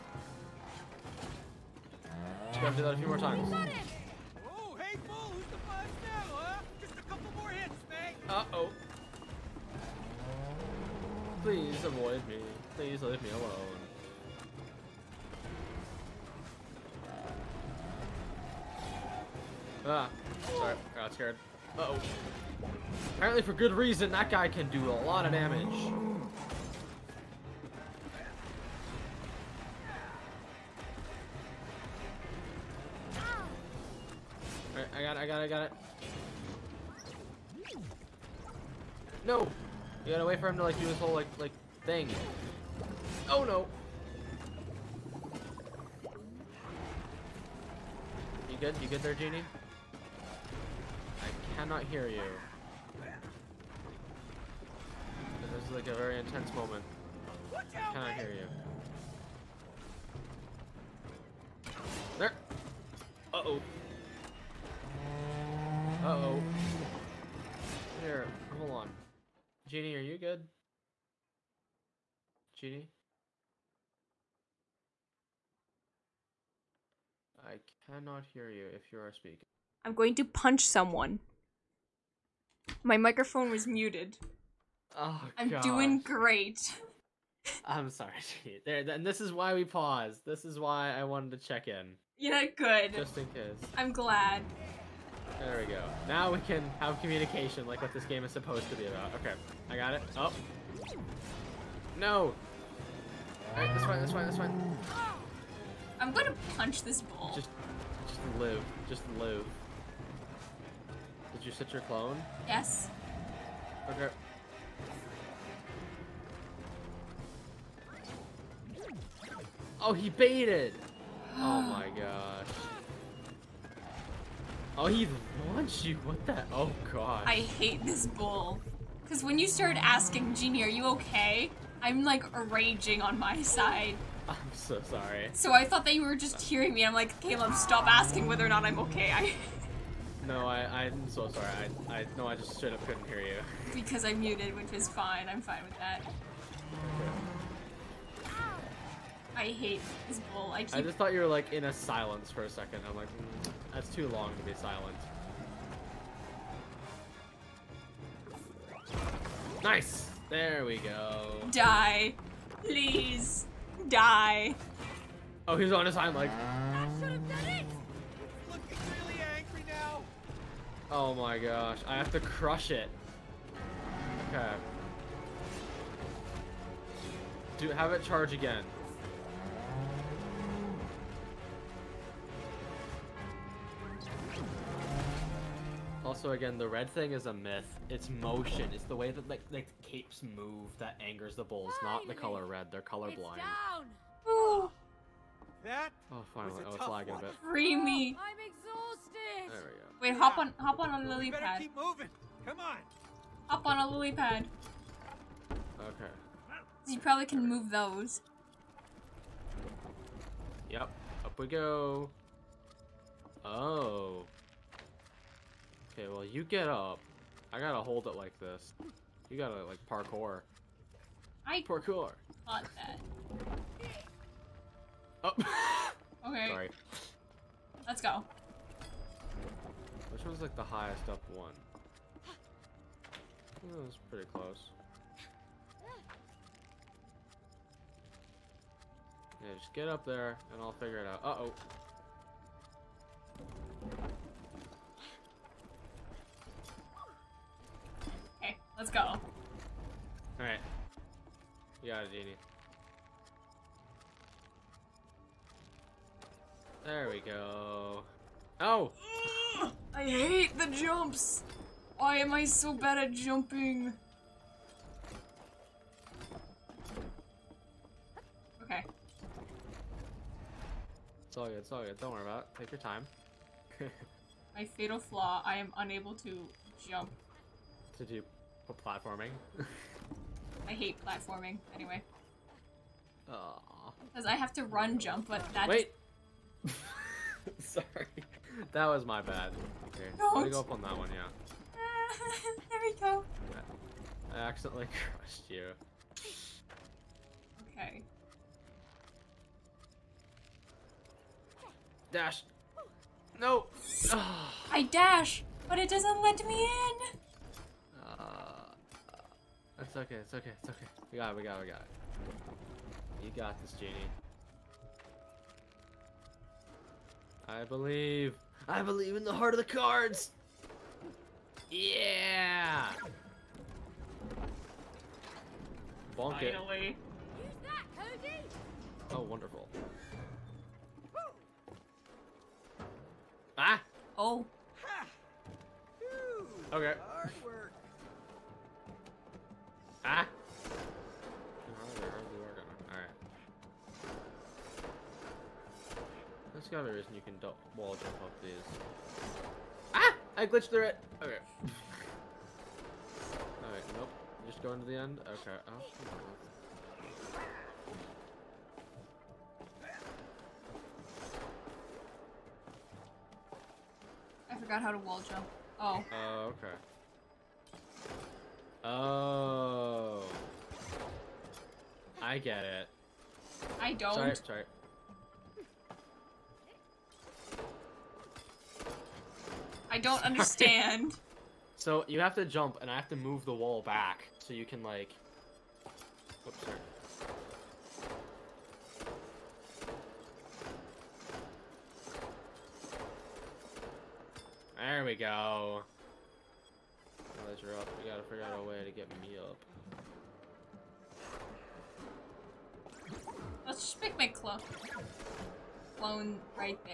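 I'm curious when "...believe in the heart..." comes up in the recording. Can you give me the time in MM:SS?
05:18.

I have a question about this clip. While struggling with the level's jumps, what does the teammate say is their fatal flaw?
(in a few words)
Unable to jump.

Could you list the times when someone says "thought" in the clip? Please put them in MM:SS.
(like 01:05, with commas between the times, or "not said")
02:15, 02:30, 03:42.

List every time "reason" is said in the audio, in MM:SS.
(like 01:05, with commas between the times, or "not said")
00:23, 05:46.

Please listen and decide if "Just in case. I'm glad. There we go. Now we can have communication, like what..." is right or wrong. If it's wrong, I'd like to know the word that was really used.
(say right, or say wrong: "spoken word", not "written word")
right.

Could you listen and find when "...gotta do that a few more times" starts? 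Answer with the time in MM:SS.
00:02.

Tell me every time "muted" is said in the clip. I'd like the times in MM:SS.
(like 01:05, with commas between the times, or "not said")
01:23, 02:24.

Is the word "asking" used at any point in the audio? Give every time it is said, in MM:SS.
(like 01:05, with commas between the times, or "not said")
02:09, 02:17.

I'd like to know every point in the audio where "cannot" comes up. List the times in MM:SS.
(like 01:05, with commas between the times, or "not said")
00:51, 00:57, 01:17.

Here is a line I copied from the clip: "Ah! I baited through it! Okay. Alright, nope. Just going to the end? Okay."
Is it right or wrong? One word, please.
wrong.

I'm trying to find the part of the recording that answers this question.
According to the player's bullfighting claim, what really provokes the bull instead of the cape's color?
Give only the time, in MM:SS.
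03:07.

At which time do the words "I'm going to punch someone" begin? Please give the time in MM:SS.
01:19.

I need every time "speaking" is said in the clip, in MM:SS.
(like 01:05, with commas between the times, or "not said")
01:19.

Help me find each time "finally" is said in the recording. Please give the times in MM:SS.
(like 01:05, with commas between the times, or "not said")
03:16, 05:26.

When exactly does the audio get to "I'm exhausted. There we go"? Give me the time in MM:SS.
03:18.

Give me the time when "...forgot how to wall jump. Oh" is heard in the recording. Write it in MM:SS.
06:04.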